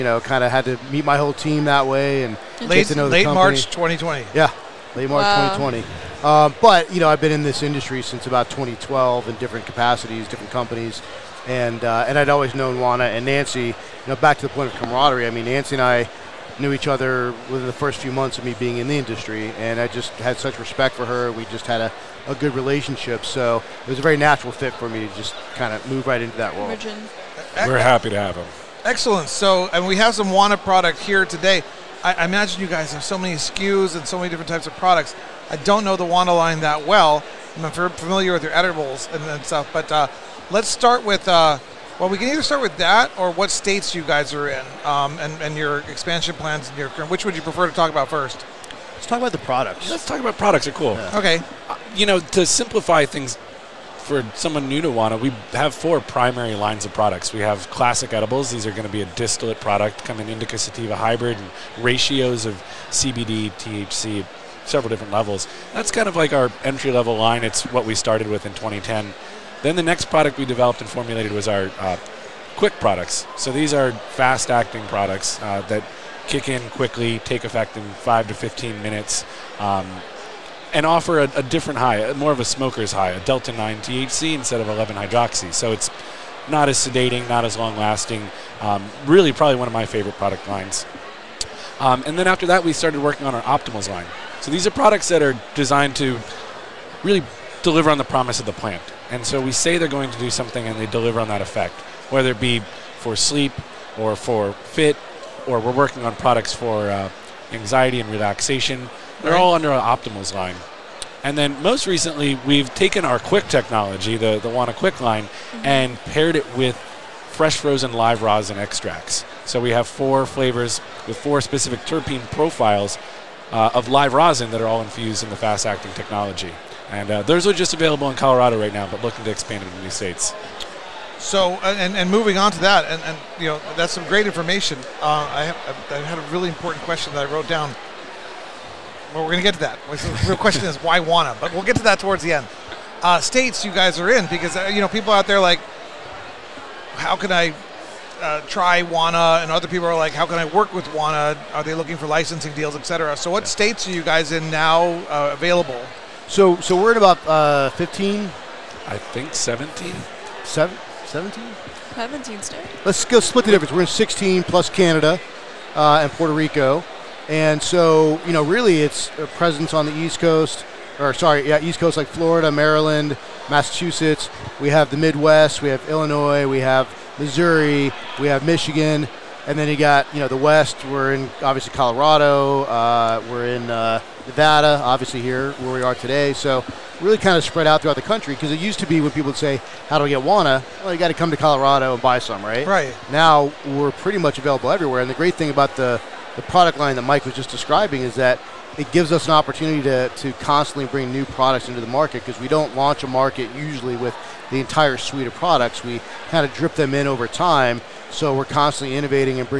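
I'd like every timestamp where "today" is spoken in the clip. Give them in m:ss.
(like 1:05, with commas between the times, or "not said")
0:31, 3:05.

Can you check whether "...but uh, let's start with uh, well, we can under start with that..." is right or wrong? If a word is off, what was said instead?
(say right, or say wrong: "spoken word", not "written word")
wrong: "either", not "under".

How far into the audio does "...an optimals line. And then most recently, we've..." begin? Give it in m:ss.
1:49.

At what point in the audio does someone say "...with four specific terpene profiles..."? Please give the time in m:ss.
2:01.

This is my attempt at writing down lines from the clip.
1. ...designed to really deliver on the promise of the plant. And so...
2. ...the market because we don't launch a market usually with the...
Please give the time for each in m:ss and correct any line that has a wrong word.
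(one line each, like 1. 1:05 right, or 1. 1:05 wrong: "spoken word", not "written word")
1. 1:35 right
2. 3:21 right.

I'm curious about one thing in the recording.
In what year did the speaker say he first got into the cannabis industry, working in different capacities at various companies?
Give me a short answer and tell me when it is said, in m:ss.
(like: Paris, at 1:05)
2012, at 0:08.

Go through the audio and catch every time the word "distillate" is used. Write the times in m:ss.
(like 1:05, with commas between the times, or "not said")
0:59.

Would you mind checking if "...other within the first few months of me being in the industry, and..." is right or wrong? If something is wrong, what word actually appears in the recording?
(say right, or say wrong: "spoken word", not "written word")
right.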